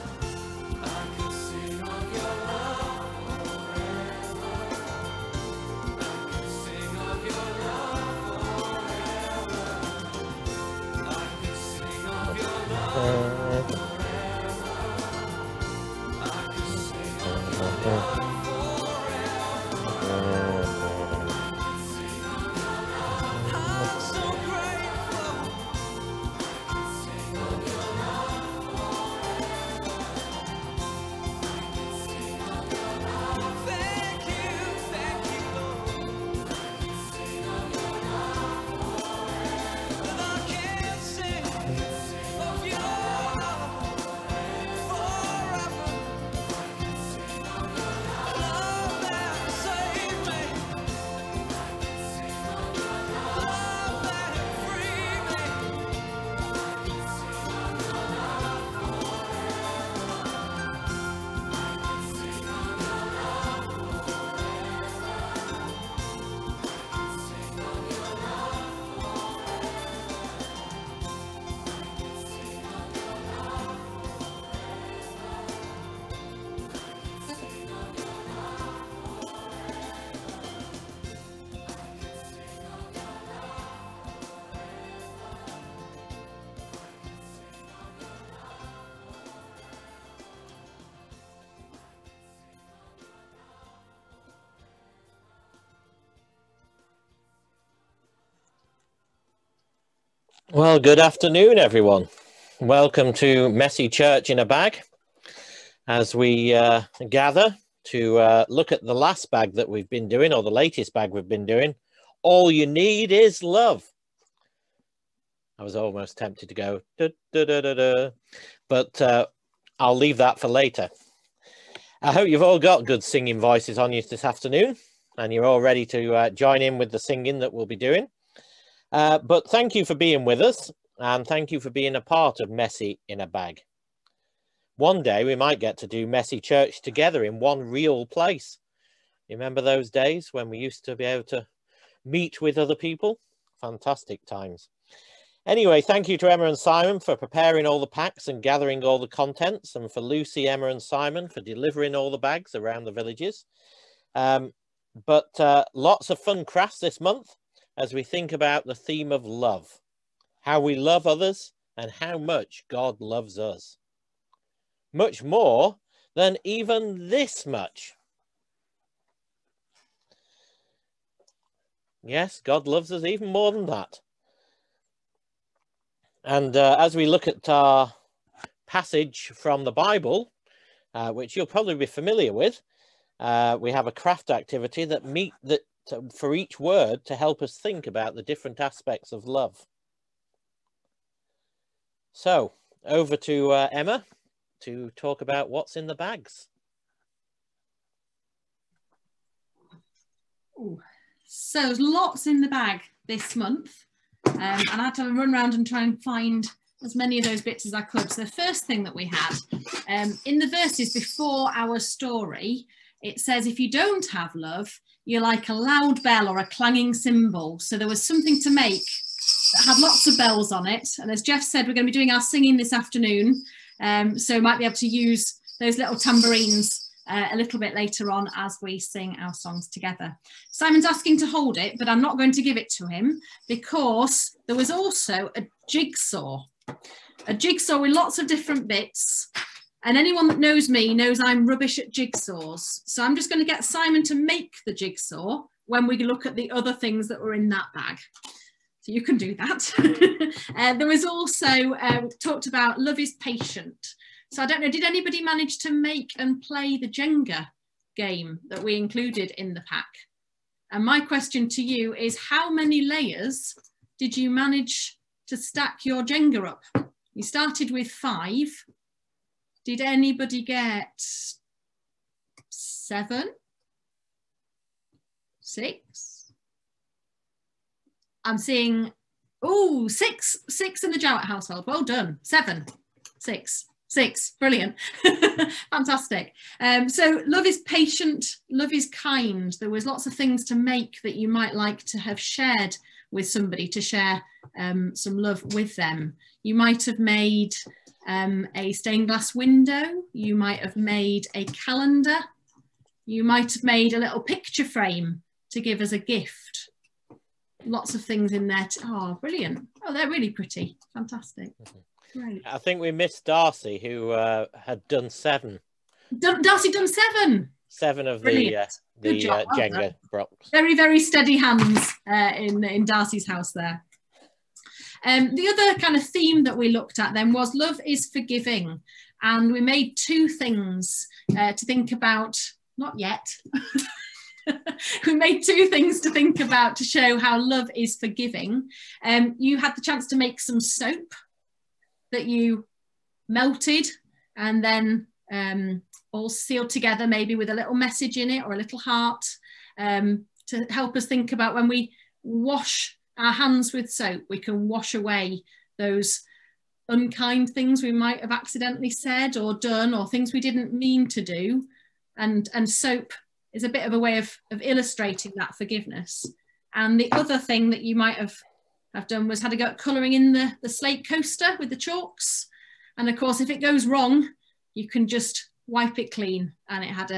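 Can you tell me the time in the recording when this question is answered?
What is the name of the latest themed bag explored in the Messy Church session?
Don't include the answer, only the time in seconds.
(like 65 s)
112 s.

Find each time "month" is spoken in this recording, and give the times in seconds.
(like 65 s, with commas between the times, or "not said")
157 s, 203 s.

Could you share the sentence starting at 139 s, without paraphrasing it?
You remember those days when we used to be able to meet with other people?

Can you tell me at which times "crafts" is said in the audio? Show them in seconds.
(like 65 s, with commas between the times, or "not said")
156 s, 183 s.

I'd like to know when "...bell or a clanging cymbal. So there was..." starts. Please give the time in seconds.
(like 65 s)
216 s.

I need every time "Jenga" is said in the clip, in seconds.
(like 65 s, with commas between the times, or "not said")
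256 s, 266 s, 319 s.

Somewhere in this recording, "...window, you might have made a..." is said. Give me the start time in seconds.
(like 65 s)
299 s.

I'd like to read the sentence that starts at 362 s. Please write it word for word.
And, and soap is a bit of a way of, of illustrating that forgiveness.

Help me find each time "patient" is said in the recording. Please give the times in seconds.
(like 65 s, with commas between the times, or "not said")
253 s, 287 s.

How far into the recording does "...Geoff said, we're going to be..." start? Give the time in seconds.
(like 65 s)
221 s.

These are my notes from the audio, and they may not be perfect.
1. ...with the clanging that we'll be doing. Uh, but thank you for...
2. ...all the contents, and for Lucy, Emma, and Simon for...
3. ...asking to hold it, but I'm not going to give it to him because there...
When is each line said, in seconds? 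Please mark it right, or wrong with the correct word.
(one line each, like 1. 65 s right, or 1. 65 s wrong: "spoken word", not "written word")
1. 126 s wrong: "singing", not "clanging"
2. 148 s right
3. 230 s right.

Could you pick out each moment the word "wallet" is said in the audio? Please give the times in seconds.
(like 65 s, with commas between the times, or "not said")
not said.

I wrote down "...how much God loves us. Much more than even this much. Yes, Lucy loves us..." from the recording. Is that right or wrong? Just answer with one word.
wrong.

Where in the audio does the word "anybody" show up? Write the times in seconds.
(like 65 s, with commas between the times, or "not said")
254 s, 269 s.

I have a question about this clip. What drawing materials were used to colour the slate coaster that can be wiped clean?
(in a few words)
Chalks.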